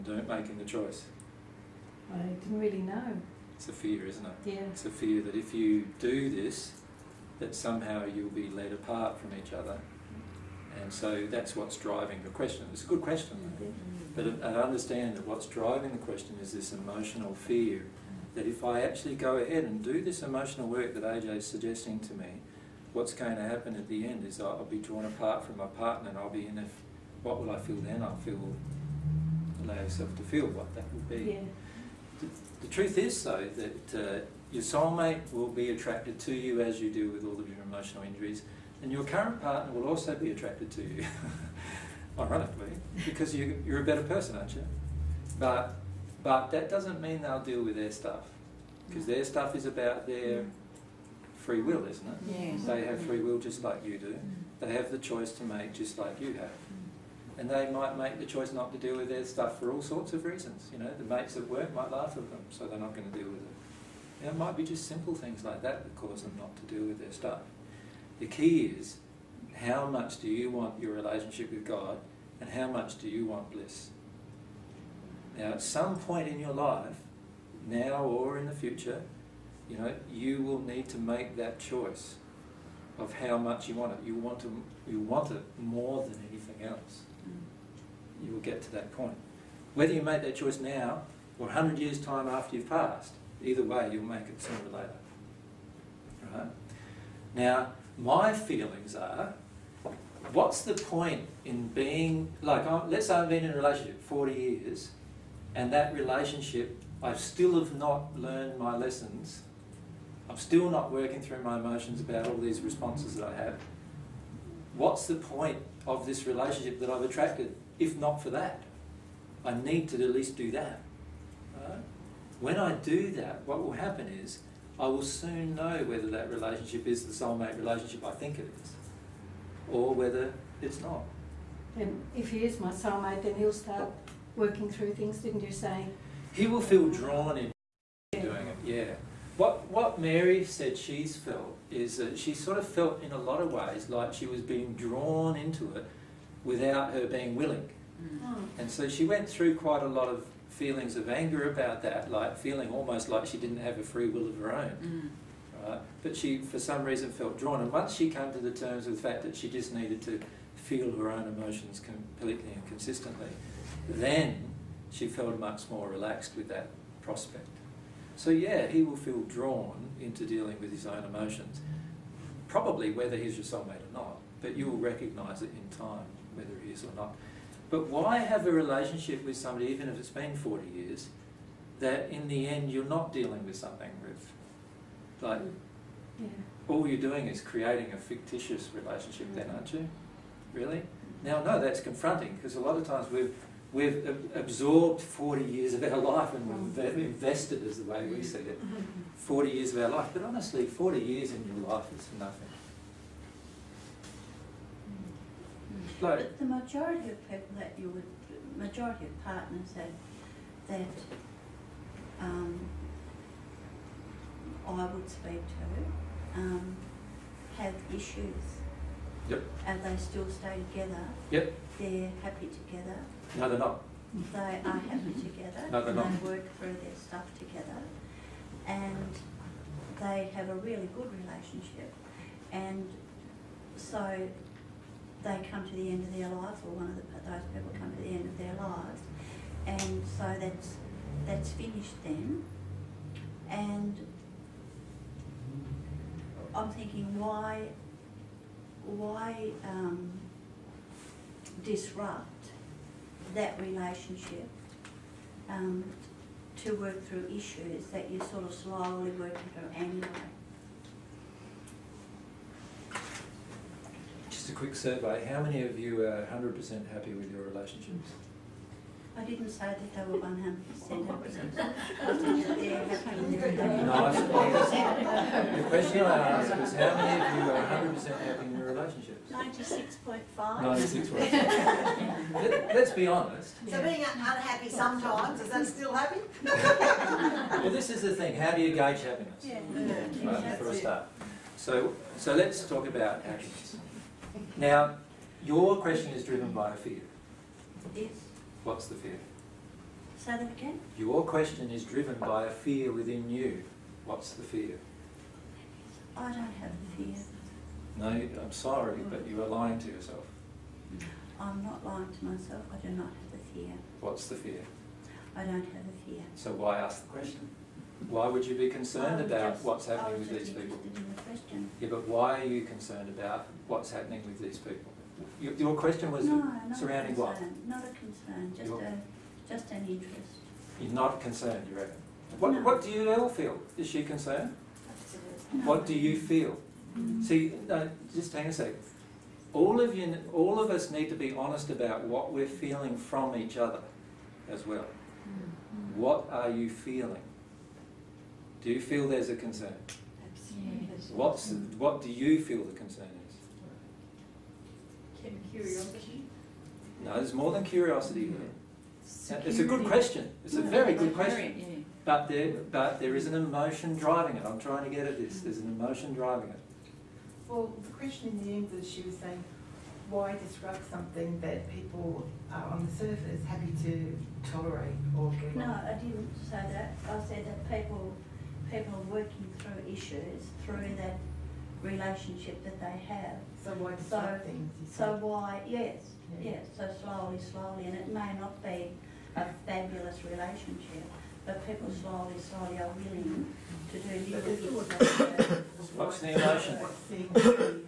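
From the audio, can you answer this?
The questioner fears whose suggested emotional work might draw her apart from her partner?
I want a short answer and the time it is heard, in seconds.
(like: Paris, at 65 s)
AJ, at 21 s.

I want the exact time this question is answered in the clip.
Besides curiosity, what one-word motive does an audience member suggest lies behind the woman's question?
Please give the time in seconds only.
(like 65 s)
359 s.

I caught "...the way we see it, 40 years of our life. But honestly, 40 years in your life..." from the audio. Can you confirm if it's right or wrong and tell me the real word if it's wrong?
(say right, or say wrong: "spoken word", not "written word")
right.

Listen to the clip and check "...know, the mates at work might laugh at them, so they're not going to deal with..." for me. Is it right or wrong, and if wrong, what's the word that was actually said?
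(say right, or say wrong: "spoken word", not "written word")
right.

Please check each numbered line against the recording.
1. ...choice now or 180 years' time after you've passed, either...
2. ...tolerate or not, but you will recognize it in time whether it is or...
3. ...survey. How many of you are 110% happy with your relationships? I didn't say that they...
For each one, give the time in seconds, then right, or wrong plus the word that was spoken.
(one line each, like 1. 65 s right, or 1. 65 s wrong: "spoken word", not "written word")
1. 90 s wrong: "100", not "180"
2. 173 s wrong: "soulmate", not "tolerate"
3. 264 s wrong: "100", not "110".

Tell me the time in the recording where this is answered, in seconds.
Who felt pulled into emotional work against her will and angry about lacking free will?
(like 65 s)
139 s.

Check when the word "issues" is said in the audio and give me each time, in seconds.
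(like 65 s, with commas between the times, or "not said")
217 s, 257 s, 379 s.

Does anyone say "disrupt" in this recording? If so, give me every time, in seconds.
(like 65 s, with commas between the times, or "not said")
251 s, 370 s.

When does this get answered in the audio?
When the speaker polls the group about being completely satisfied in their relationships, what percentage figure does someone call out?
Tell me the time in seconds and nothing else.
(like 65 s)
279 s.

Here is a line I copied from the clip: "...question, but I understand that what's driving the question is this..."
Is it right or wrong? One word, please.
right.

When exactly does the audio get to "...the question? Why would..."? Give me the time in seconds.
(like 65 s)
317 s.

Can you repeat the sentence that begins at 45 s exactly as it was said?
But, but that doesn't mean they'll deal with their stuff, because their stuff is about their free will, isn't it?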